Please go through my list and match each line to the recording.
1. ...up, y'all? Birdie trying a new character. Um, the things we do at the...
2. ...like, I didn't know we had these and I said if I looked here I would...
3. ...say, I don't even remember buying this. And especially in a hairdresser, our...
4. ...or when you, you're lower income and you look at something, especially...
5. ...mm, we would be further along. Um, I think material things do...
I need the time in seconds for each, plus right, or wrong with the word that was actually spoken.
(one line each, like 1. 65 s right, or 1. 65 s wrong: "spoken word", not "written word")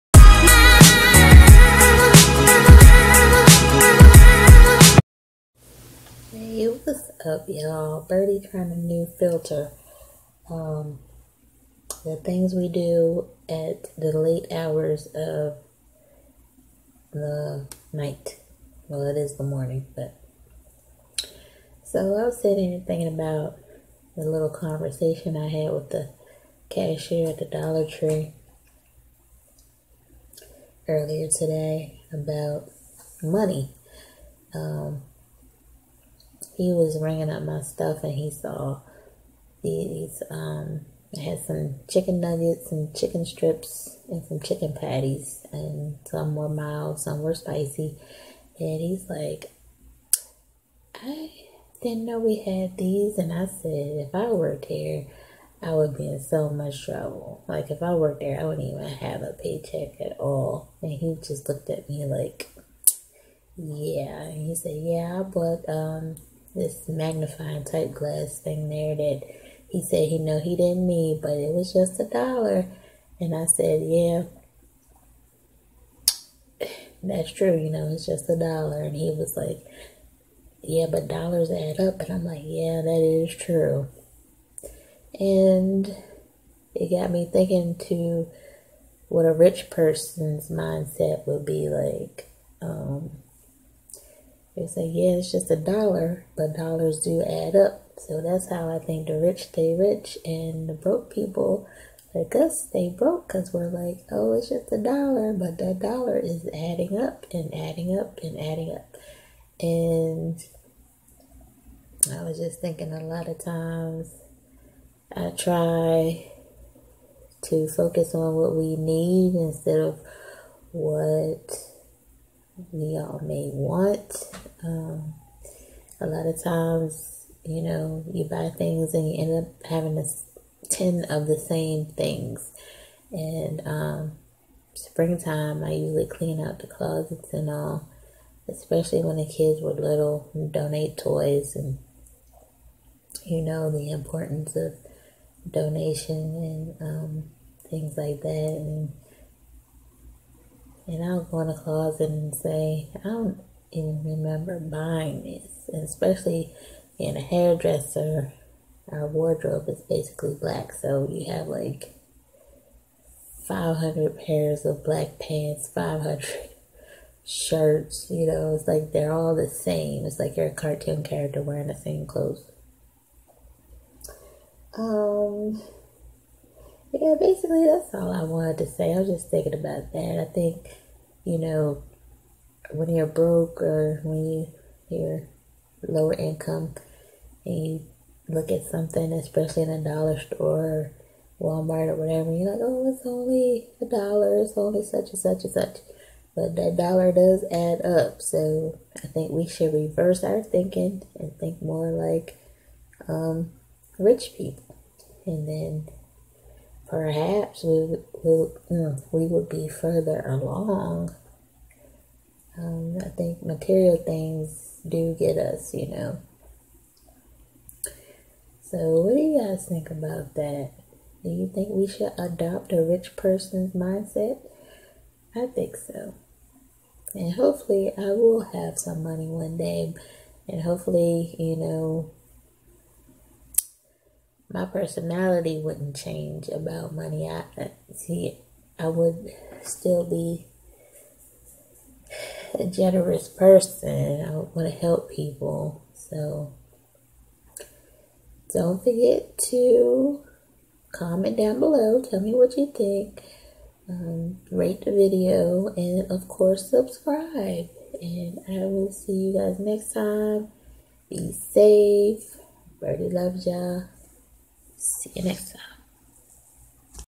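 1. 7 s wrong: "filter", not "character"
2. 49 s wrong: "worked", not "looked"
3. 152 s right
4. 183 s right
5. 208 s right.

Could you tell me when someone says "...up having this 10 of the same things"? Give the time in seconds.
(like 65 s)
129 s.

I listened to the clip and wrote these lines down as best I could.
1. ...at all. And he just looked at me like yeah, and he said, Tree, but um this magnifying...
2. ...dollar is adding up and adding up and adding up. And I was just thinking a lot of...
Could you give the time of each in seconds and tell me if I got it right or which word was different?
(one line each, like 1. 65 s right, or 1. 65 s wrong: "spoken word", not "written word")
1. 59 s wrong: "Yeah", not "Tree"
2. 105 s right.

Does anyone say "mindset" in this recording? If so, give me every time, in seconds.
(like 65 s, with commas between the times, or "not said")
90 s, 223 s.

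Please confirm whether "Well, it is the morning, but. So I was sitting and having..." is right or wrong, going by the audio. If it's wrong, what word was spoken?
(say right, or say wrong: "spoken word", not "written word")
wrong: "thinking", not "having".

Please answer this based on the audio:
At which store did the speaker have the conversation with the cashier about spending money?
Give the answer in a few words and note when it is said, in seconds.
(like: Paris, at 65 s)
Dollar Tree, at 27 s.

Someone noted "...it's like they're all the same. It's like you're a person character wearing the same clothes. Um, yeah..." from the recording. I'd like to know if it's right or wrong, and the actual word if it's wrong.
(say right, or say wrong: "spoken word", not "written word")
wrong: "cartoon", not "person".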